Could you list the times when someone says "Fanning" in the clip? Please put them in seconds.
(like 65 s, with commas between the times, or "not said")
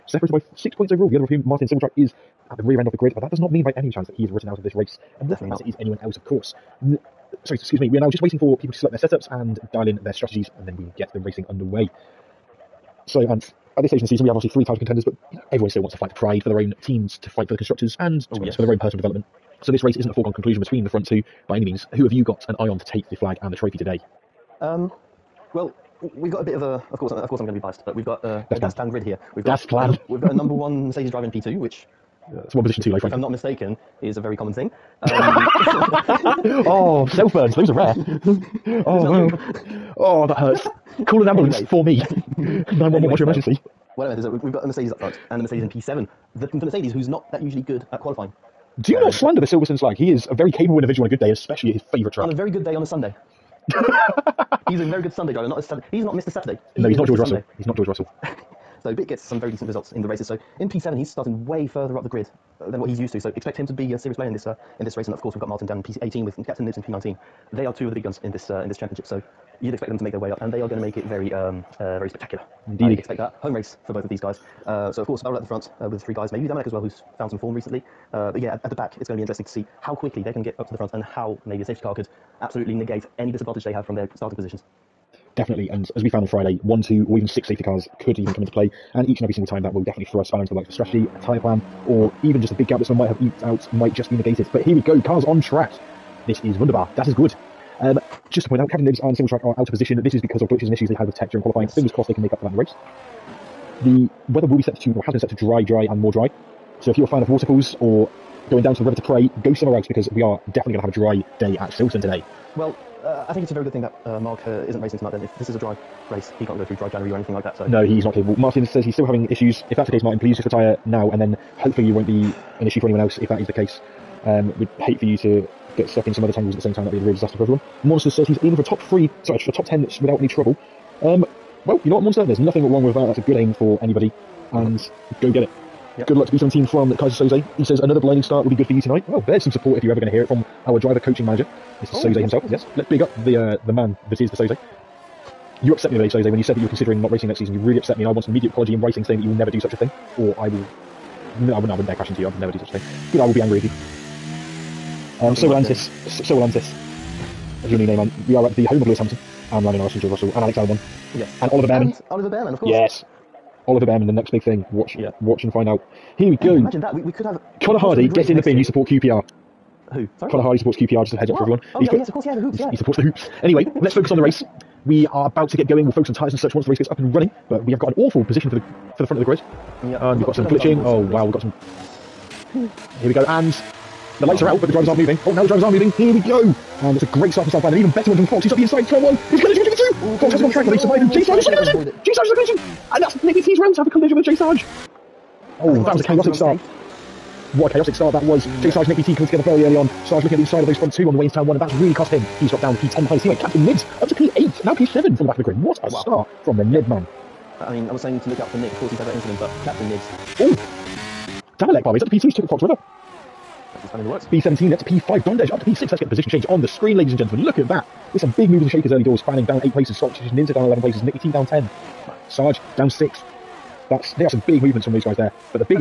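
219 s.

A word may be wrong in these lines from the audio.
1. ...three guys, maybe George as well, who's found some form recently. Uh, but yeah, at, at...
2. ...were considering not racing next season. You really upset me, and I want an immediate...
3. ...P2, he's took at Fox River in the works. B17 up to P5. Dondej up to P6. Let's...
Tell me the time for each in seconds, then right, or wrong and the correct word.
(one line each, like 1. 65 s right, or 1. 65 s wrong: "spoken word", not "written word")
1. 76 s wrong: "Damalek", not "George"
2. 146 s right
3. 212 s right.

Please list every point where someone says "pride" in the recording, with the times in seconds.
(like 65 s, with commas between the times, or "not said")
16 s.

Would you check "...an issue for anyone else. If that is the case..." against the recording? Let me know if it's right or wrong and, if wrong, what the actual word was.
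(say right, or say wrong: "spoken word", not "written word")
right.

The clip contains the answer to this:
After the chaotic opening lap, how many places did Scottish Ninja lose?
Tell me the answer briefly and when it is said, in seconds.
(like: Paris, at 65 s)
11, at 220 s.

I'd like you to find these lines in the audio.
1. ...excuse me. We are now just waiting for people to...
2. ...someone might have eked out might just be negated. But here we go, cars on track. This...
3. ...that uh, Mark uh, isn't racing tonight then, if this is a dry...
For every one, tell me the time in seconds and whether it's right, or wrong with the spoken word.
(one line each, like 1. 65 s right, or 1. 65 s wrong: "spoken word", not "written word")
1. 7 s right
2. 92 s right
3. 113 s right.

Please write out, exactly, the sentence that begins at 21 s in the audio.
Who have you got an eye on to take the flag and the trophy today?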